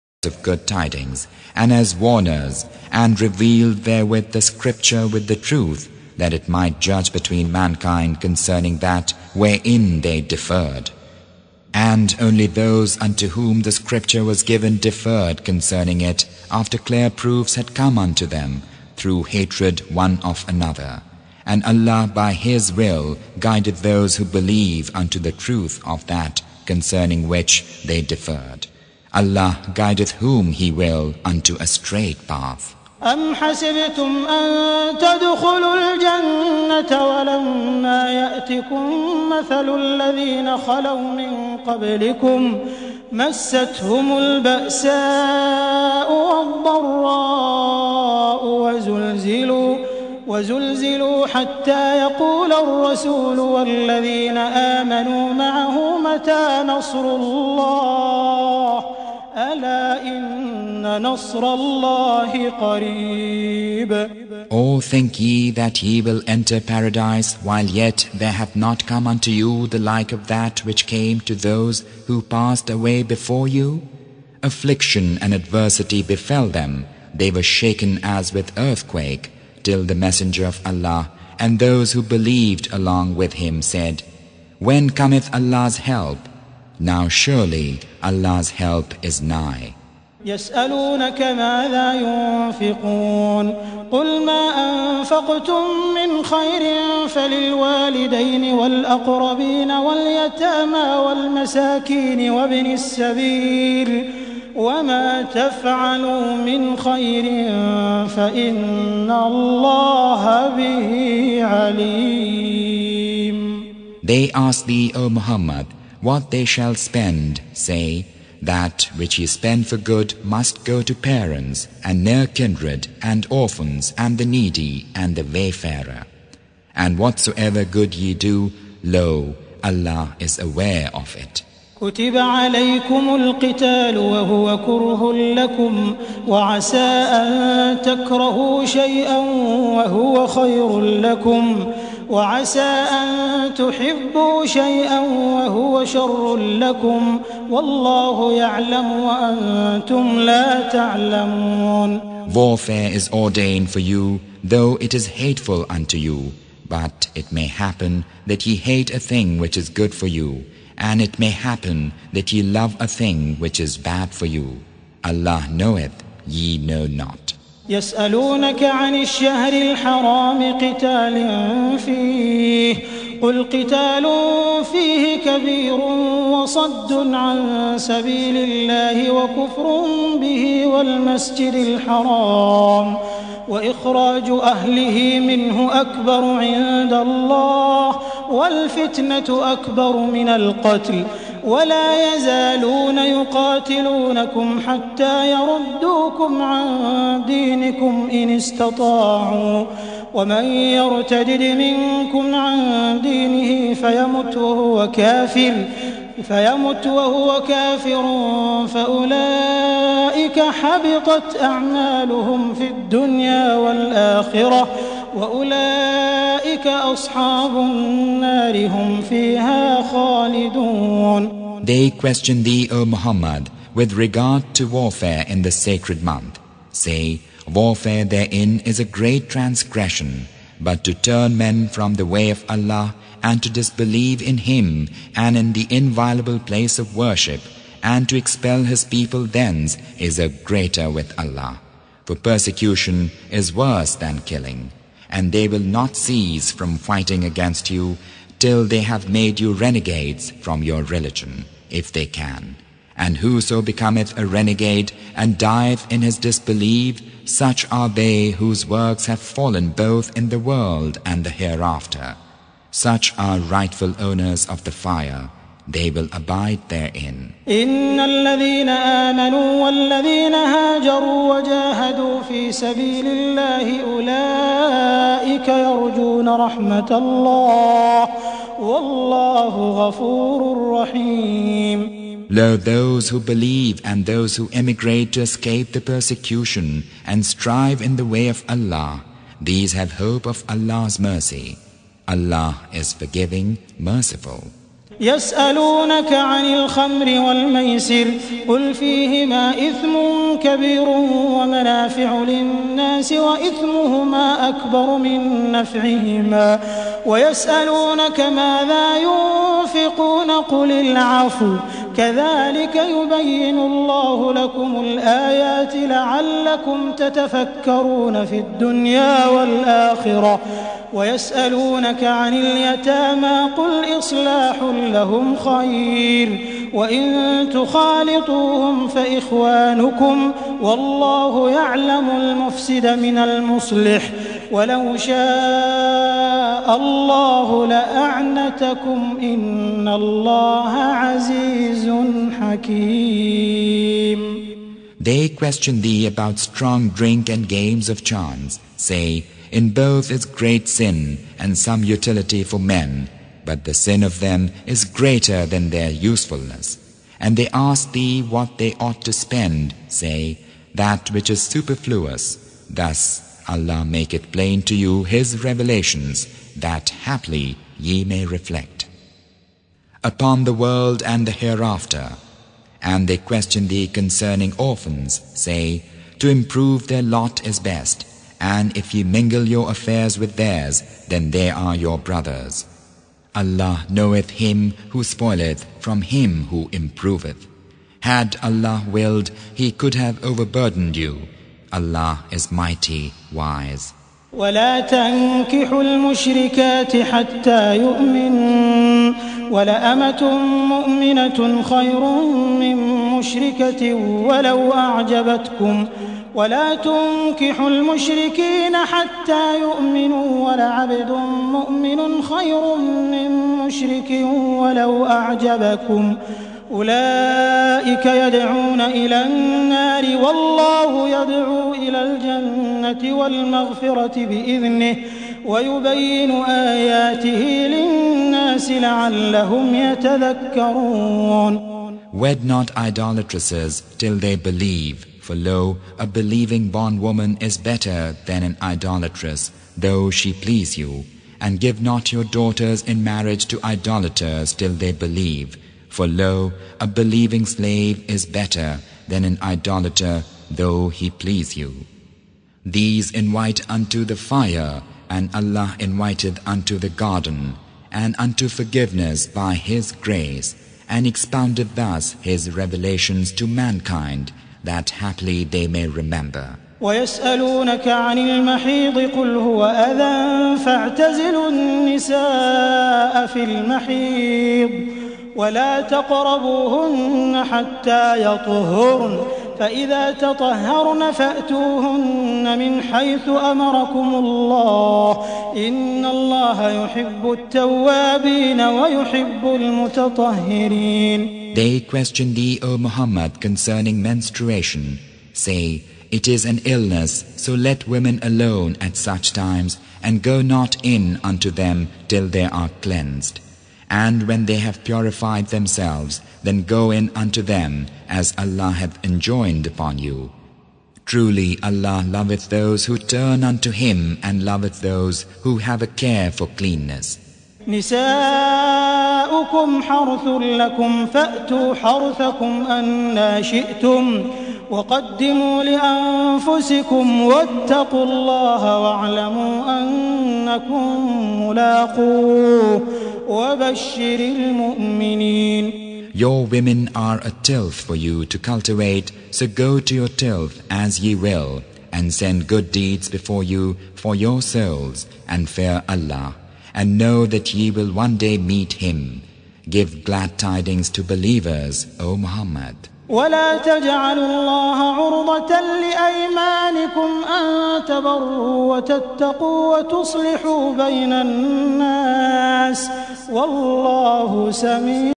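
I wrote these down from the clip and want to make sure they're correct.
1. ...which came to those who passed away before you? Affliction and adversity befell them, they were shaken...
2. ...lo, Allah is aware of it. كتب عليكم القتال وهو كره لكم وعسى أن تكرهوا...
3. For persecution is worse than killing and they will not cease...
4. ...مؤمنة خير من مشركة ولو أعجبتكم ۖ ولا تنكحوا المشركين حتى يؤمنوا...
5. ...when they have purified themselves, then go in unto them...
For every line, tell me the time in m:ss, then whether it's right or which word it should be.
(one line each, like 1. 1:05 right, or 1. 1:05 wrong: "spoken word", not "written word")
1. 1:10 right
2. 2:08 right
3. 4:02 right
4. 6:40 right
5. 8:24 right.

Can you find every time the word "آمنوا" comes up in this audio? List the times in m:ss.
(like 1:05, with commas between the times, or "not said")
0:54, 4:28.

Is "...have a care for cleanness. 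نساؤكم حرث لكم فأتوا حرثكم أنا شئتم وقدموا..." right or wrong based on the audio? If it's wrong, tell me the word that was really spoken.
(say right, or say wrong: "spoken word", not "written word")
right.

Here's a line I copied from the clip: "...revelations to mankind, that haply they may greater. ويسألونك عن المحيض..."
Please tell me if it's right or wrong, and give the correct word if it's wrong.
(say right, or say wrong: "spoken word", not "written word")
wrong: "remember", not "greater".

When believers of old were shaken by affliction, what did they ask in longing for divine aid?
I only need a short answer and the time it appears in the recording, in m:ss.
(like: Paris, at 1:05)
When cometh Allah's help?, at 1:24.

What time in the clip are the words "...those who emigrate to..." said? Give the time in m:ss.
4:44.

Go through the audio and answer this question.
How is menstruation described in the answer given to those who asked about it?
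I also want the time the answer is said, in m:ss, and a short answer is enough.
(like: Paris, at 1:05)
an illness, at 8:16.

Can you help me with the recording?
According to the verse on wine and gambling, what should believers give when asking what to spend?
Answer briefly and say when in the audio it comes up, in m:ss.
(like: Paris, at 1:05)
that which is superfluous, at 6:00.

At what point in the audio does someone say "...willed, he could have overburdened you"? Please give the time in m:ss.
6:28.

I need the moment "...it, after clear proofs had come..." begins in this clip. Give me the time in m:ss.
0:16.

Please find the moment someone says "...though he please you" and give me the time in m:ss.
7:30.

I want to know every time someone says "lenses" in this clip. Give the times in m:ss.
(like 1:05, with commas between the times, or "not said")
not said.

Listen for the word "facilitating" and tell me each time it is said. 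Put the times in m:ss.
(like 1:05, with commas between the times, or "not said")
not said.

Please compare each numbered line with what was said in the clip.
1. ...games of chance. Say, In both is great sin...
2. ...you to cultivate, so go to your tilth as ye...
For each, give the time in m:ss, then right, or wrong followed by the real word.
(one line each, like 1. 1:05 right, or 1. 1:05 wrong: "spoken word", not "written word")
1. 5:47 right
2. 8:57 right.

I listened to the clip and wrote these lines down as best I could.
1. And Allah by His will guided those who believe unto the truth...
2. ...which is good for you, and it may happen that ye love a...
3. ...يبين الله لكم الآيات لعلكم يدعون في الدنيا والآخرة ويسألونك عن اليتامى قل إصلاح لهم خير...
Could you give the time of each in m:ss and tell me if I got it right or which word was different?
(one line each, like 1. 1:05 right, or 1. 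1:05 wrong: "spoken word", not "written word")
1. 0:21 right
2. 2:39 right
3. 5:12 wrong: "تتفكرون", not "يدعون".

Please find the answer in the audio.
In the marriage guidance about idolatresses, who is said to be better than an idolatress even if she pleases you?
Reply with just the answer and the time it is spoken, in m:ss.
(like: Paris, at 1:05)
a believing bondwoman, at 7:15.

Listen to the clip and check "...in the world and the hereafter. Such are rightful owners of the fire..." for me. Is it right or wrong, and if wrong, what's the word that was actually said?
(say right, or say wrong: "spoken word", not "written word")
right.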